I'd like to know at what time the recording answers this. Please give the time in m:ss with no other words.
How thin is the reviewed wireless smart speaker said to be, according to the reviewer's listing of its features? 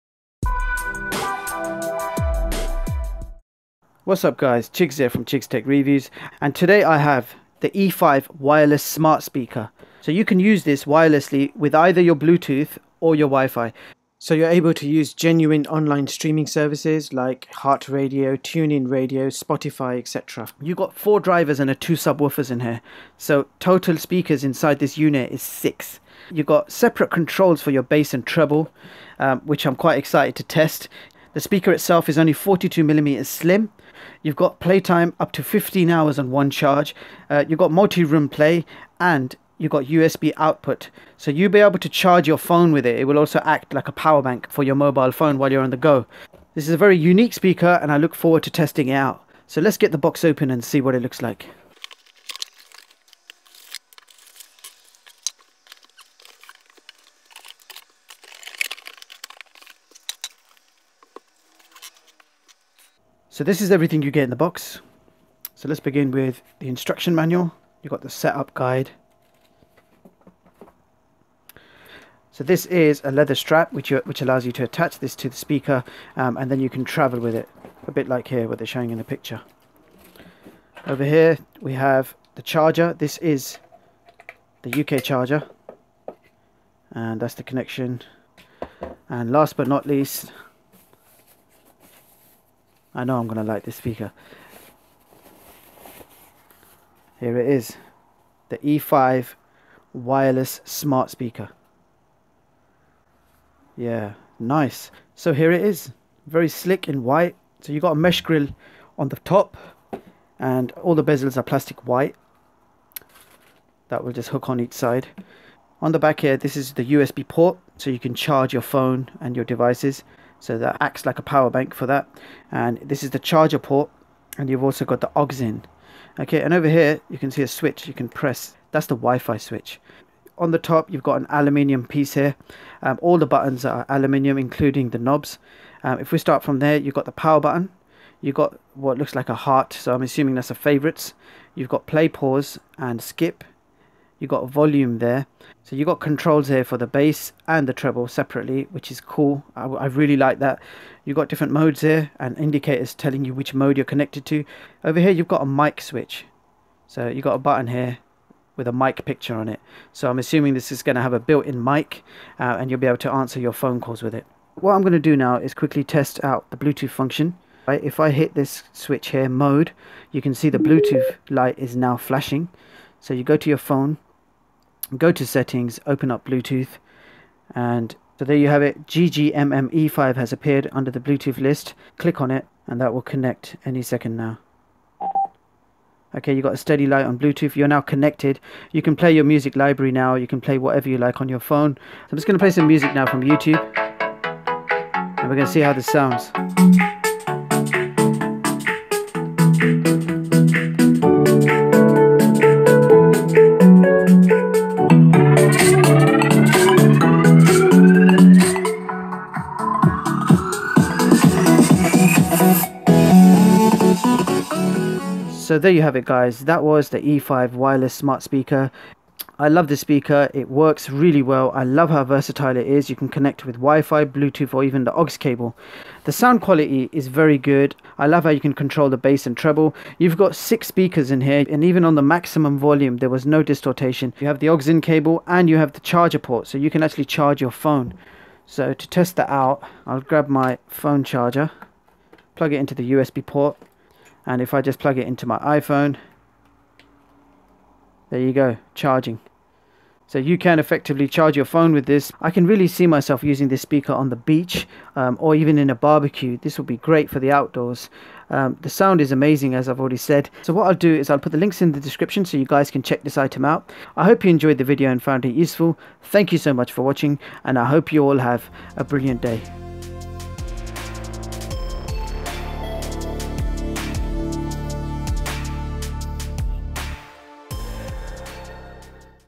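0:32.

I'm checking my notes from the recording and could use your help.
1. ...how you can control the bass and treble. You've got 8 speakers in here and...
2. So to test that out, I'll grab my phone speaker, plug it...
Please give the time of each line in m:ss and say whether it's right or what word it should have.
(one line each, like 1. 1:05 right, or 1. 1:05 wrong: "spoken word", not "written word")
1. 3:48 wrong: "6", not "8"
2. 3:58 wrong: "charger", not "speaker".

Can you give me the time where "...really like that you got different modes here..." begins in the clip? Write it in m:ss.
2:29.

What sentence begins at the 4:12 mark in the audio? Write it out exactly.
I can really see myself using this speaker on the beach um, or even in a barbecue.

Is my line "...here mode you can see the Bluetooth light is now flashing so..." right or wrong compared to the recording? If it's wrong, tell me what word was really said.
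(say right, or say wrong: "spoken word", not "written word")
right.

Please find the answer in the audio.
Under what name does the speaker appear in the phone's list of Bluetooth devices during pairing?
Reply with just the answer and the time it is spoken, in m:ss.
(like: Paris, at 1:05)
GGMME5, at 2:58.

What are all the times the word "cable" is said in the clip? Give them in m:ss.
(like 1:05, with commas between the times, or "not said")
3:45, 3:54.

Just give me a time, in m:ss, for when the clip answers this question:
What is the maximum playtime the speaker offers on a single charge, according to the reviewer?
0:35.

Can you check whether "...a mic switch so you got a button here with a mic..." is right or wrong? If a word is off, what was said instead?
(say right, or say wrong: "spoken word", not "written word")
right.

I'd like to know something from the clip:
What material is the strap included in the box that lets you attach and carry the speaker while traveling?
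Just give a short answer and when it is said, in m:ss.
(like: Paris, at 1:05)
Leather, at 1:13.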